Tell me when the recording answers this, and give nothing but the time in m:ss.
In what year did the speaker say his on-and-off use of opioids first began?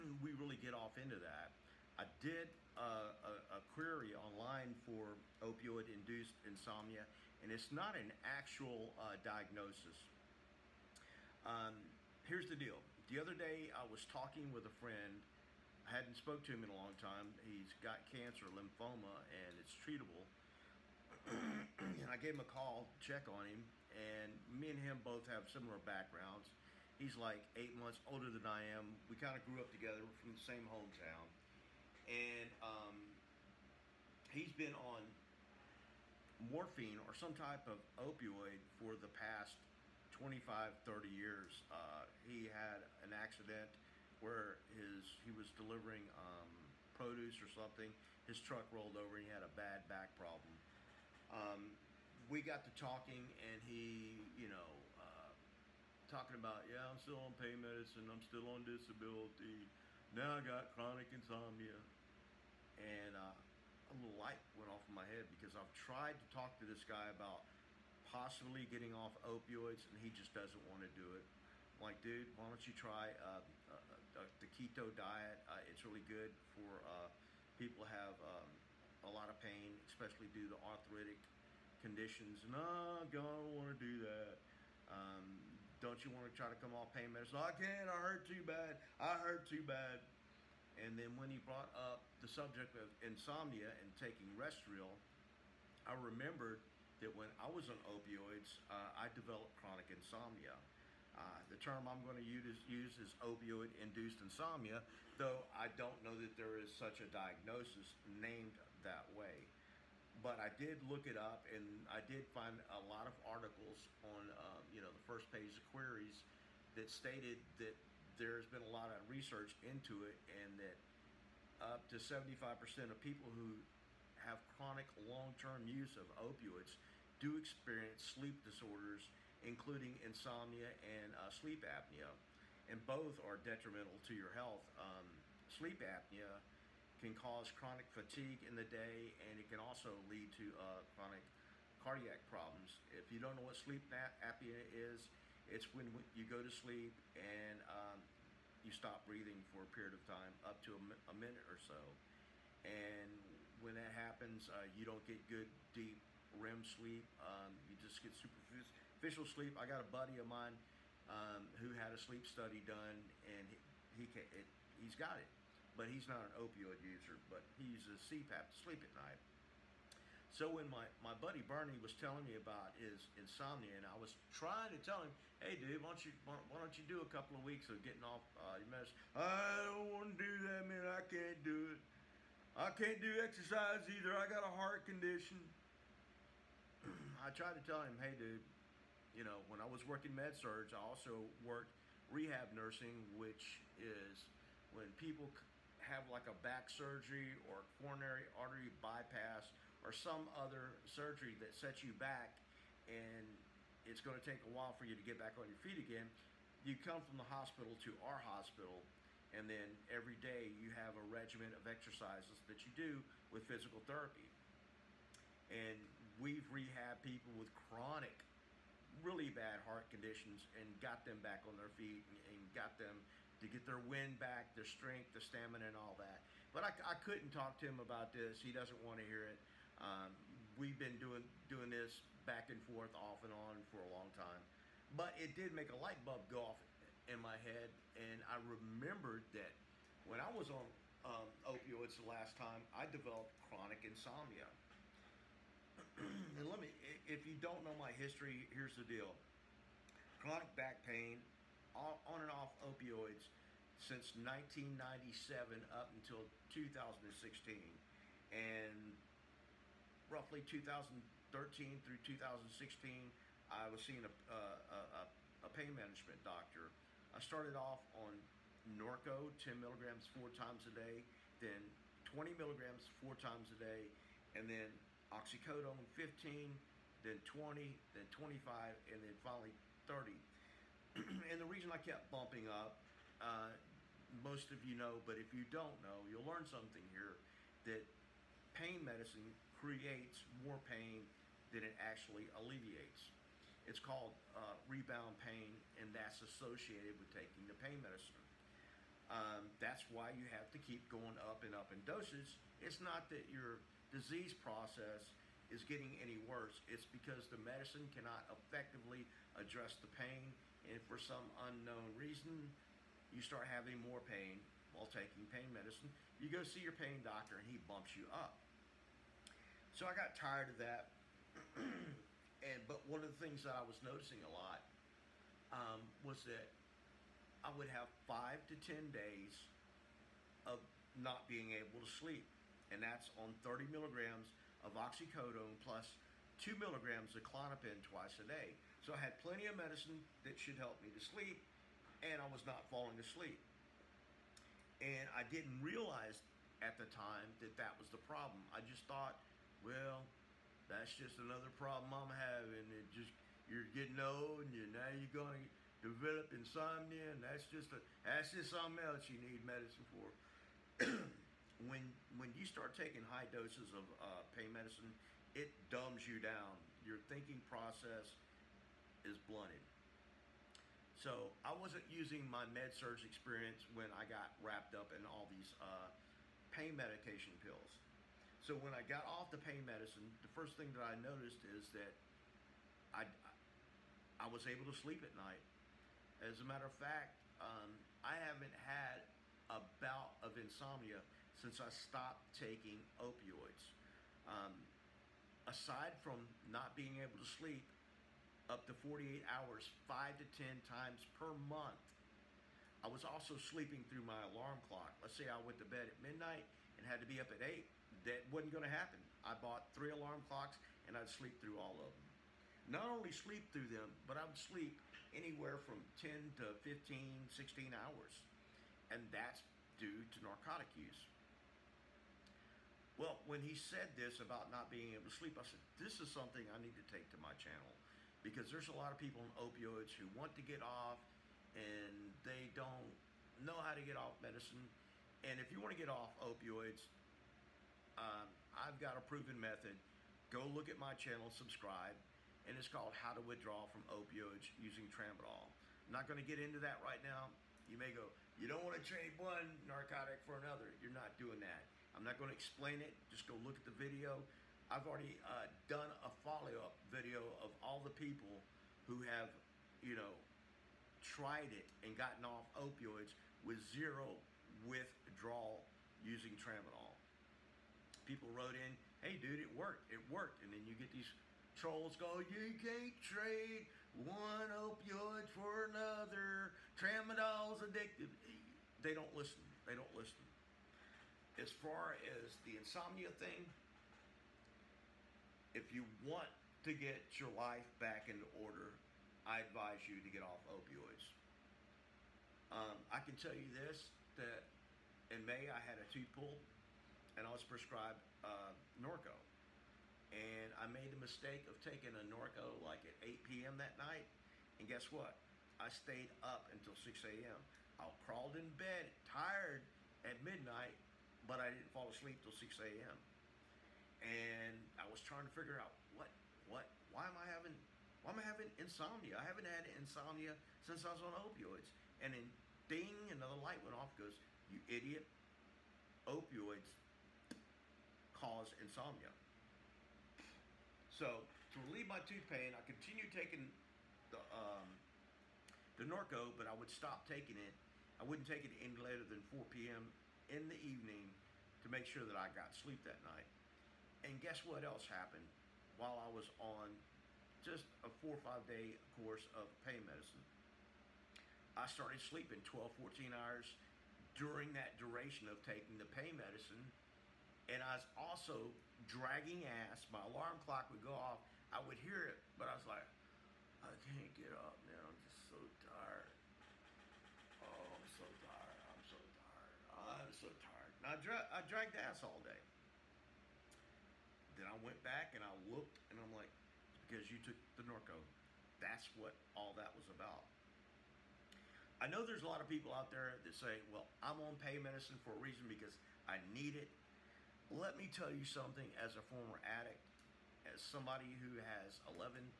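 4:14.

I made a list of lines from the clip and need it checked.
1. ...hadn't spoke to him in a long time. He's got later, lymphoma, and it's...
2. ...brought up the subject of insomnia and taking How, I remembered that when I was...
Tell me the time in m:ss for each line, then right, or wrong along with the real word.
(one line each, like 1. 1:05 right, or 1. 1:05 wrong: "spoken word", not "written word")
1. 0:15 wrong: "cancer", not "later"
2. 1:31 wrong: "Restoril", not "How".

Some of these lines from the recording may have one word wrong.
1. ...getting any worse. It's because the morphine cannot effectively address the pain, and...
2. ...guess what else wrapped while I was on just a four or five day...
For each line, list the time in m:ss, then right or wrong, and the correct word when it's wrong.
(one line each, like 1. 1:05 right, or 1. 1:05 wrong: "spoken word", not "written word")
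1. 5:05 wrong: "medicine", not "morphine"
2. 9:04 wrong: "happened", not "wrapped".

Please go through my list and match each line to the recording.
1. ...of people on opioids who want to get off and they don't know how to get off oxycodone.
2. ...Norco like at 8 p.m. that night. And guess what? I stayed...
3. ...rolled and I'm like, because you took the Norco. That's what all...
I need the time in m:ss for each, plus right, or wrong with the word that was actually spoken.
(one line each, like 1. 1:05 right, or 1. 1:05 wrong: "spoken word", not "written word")
1. 7:08 wrong: "medicine", not "oxycodone"
2. 8:21 right
3. 9:35 wrong: "looked", not "rolled".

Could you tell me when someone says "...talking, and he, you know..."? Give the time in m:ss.
0:52.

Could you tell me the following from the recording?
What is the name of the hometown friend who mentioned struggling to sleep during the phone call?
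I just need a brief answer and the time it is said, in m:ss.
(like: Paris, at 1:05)
Bernie, at 2:51.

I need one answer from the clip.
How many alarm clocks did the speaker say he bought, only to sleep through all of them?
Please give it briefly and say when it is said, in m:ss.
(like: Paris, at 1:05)
3, at 6:49.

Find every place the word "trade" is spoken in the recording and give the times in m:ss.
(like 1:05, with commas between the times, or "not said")
7:28, 7:53.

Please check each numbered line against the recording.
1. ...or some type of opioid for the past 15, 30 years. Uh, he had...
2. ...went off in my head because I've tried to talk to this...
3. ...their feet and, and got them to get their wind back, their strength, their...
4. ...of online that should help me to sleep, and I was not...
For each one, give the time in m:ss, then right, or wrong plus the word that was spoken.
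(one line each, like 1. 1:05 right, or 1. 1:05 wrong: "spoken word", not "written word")
1. 0:36 wrong: "25", not "15"
2. 1:04 right
3. 3:41 right
4. 5:39 wrong: "medicine", not "online".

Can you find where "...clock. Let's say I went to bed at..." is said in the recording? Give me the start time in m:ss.
6:44.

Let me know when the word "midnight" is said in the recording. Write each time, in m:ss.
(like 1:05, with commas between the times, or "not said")
6:46, 8:30.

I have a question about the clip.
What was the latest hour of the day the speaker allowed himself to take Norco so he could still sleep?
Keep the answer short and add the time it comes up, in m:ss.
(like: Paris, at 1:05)
4 p.m., at 8:59.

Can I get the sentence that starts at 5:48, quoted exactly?
I just thought, well, that's just another problem I'm having.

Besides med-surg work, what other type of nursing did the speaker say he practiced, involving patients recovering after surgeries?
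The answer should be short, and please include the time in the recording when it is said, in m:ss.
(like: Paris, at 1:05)
Rehab nursing, at 3:12.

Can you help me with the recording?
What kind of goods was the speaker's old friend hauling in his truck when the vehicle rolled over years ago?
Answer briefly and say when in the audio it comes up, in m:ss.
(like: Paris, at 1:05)
Produce, at 0:46.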